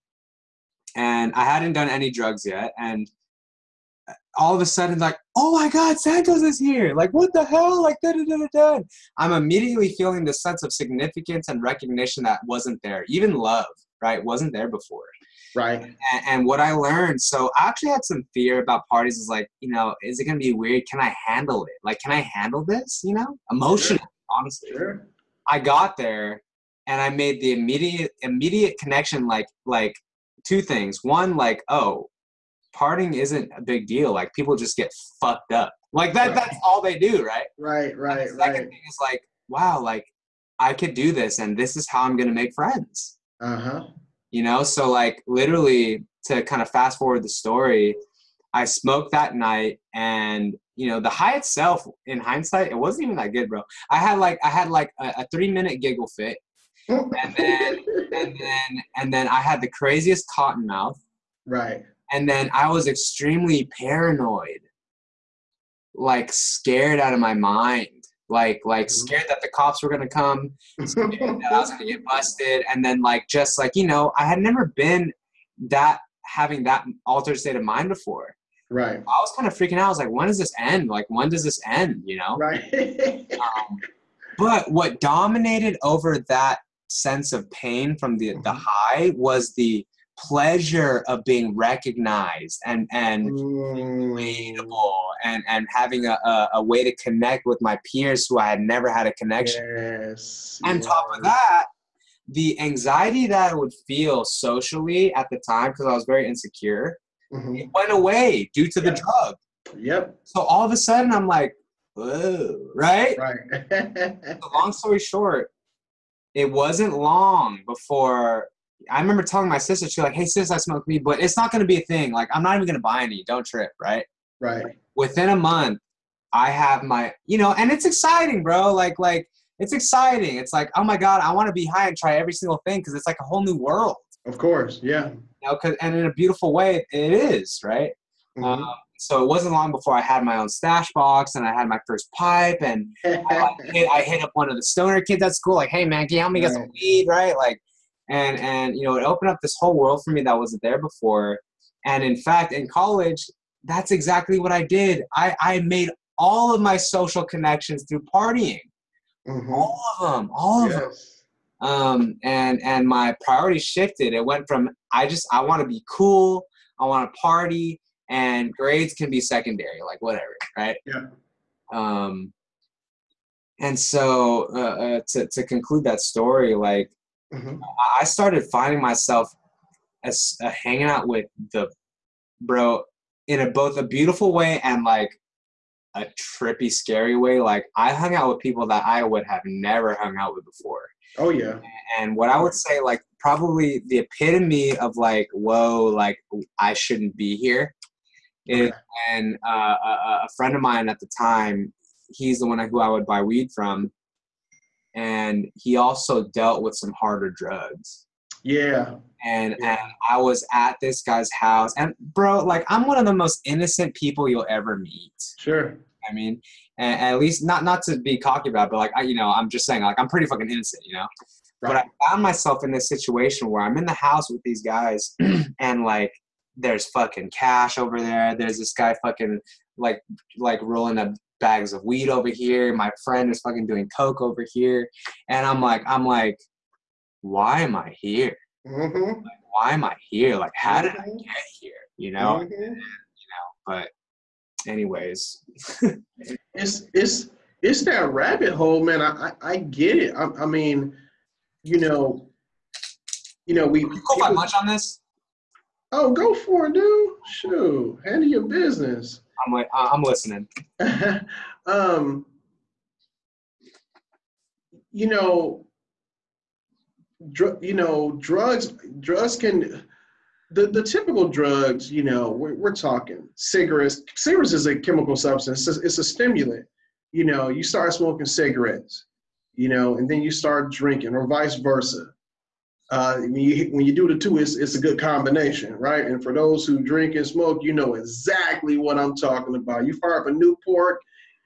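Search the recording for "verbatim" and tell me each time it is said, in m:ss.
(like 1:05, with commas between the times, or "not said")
not said.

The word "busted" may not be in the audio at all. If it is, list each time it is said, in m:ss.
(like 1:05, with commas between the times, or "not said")
1:12.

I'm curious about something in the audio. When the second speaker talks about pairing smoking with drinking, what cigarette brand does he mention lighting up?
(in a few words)
Newport.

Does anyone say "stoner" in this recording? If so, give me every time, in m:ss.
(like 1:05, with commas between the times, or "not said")
2:24.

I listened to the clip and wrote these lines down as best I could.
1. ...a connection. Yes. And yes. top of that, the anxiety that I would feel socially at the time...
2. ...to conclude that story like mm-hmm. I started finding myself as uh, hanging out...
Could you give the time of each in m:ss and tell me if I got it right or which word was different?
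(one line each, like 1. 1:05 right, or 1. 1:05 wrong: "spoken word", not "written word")
1. 1:39 right
2. 2:55 right.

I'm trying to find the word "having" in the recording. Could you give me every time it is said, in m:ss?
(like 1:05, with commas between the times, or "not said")
1:16, 1:35.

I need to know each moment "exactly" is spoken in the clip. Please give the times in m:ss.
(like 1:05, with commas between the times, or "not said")
2:33, 4:47.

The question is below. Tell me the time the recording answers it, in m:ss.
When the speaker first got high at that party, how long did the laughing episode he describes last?
0:55.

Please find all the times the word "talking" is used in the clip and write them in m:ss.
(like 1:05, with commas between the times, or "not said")
4:32, 4:49.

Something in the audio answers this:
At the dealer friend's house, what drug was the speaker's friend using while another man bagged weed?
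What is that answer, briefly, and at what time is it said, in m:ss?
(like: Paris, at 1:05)
coke, at 3:53.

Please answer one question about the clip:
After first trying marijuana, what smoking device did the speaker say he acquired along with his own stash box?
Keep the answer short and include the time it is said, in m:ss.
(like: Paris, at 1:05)
pipe, at 2:22.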